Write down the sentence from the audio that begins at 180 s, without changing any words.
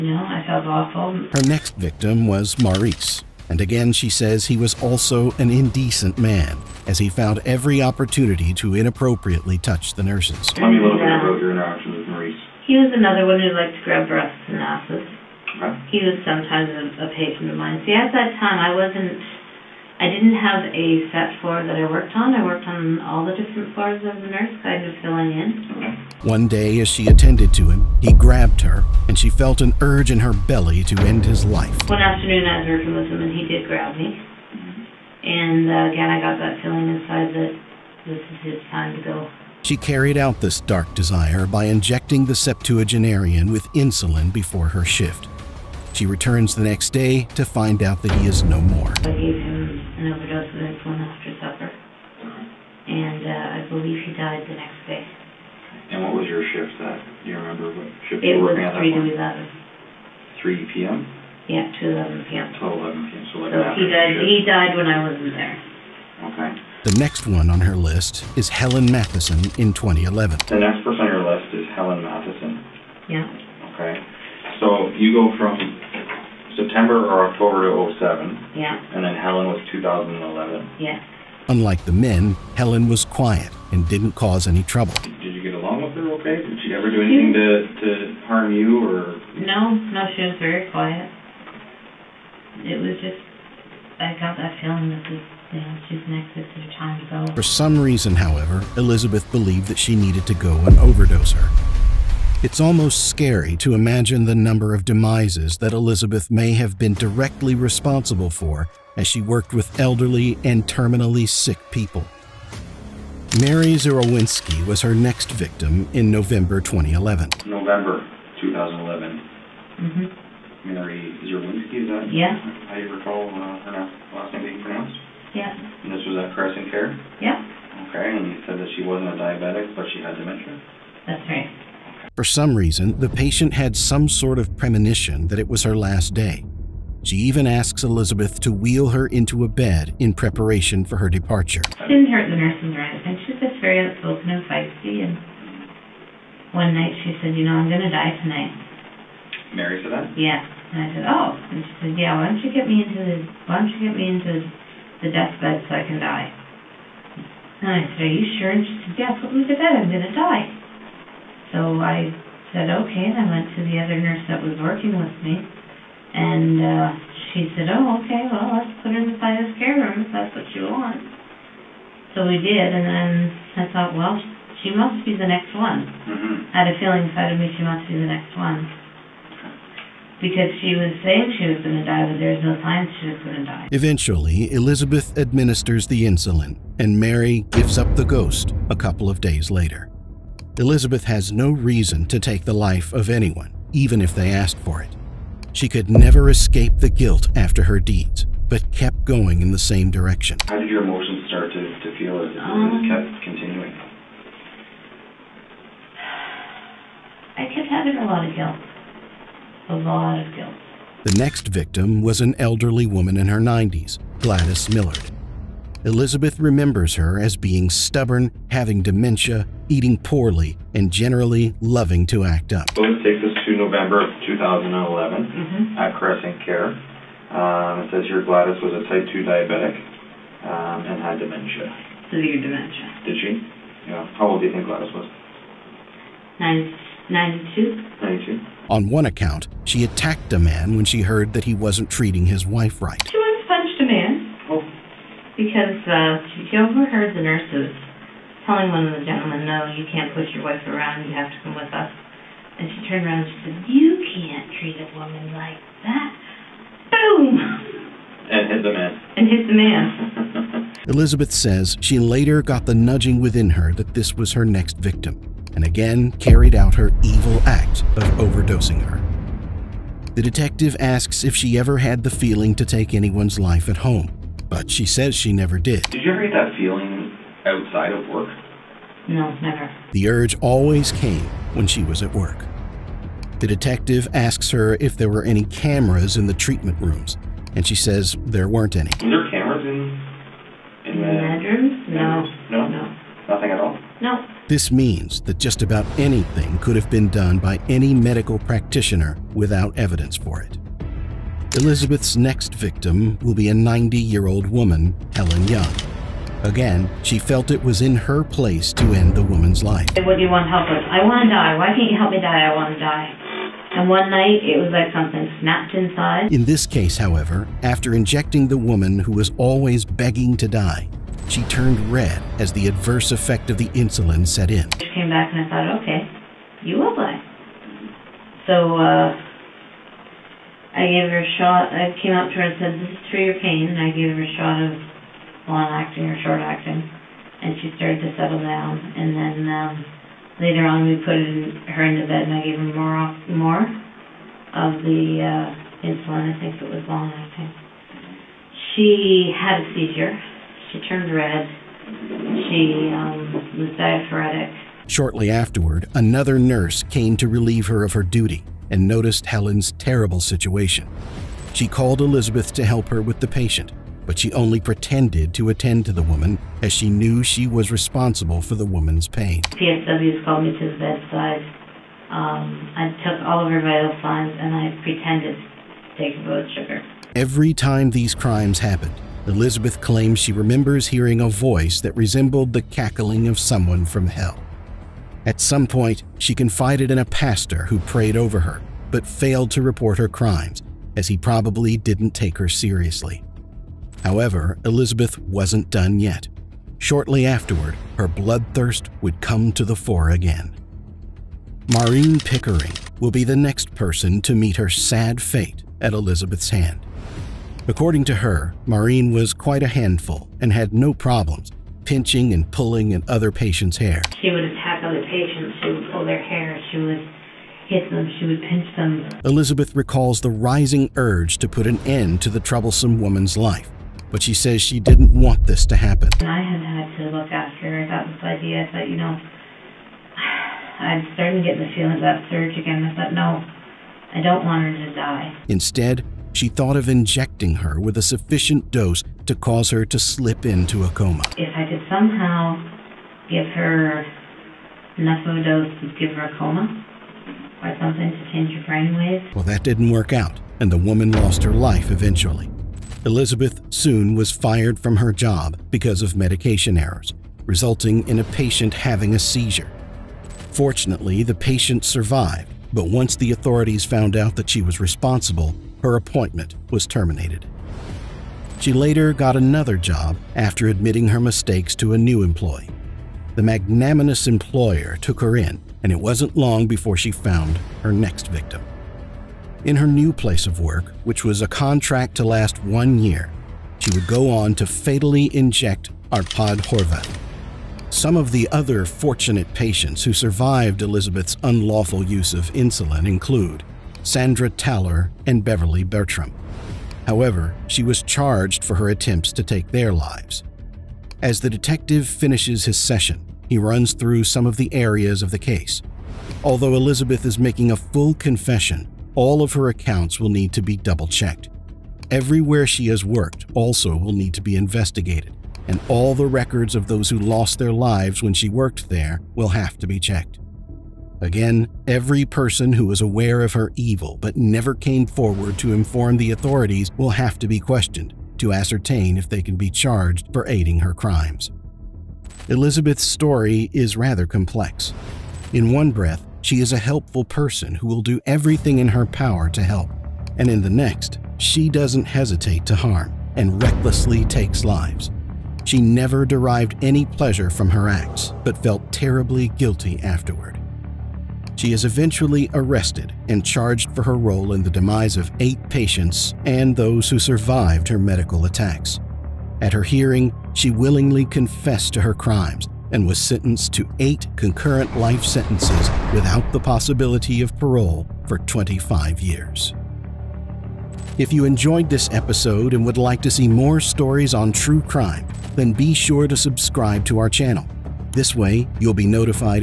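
Because she was saying she was going to die, but there was no signs she was going to die.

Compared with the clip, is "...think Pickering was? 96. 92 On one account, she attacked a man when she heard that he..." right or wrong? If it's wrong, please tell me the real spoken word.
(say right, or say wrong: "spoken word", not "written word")
wrong: "Gladys", not "Pickering".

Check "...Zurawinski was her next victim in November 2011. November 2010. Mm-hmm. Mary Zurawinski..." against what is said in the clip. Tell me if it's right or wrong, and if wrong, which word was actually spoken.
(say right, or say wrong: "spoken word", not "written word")
wrong: "2011", not "2010".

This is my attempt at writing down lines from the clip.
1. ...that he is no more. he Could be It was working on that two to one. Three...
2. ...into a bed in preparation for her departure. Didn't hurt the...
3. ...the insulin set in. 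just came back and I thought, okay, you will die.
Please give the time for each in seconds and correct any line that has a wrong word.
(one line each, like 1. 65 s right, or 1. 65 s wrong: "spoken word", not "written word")
1. 48 s wrong: "three", not "two"
2. 139 s right
3. 323 s right.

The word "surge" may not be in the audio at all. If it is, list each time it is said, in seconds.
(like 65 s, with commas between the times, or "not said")
432 s.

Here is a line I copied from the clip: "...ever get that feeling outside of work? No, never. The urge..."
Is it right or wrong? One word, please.
right.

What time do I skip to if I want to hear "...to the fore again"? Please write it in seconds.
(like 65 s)
399 s.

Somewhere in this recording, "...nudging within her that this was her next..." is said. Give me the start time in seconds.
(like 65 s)
262 s.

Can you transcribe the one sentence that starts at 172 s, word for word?
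And then I thought, well, she must be the next one.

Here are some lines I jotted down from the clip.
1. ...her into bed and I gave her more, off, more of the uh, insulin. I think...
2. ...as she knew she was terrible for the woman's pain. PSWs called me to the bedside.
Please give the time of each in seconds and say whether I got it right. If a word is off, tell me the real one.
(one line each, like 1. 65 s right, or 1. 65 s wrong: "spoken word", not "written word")
1. 341 s right
2. 366 s wrong: "responsible", not "terrible".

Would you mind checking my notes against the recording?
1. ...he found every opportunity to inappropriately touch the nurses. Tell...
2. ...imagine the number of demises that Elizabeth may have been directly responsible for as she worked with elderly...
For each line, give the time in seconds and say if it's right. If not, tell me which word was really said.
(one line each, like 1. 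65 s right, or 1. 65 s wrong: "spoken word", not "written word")
1. 6 s right
2. 103 s right.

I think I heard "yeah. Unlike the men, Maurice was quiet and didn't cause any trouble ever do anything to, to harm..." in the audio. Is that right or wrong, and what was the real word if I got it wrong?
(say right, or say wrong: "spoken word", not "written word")
wrong: "Helen", not "Maurice".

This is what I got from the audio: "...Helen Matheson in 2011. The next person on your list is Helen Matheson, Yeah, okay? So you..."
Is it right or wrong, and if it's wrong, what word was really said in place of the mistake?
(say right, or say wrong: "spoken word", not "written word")
right.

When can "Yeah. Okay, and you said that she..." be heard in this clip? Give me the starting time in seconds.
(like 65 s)
127 s.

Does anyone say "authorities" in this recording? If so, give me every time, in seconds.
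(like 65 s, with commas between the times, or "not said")
463 s, 526 s.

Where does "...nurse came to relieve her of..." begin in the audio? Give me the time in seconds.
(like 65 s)
356 s.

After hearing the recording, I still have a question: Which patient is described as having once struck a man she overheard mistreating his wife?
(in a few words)
Gladys Millard.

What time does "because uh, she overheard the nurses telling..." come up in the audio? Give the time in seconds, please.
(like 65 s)
245 s.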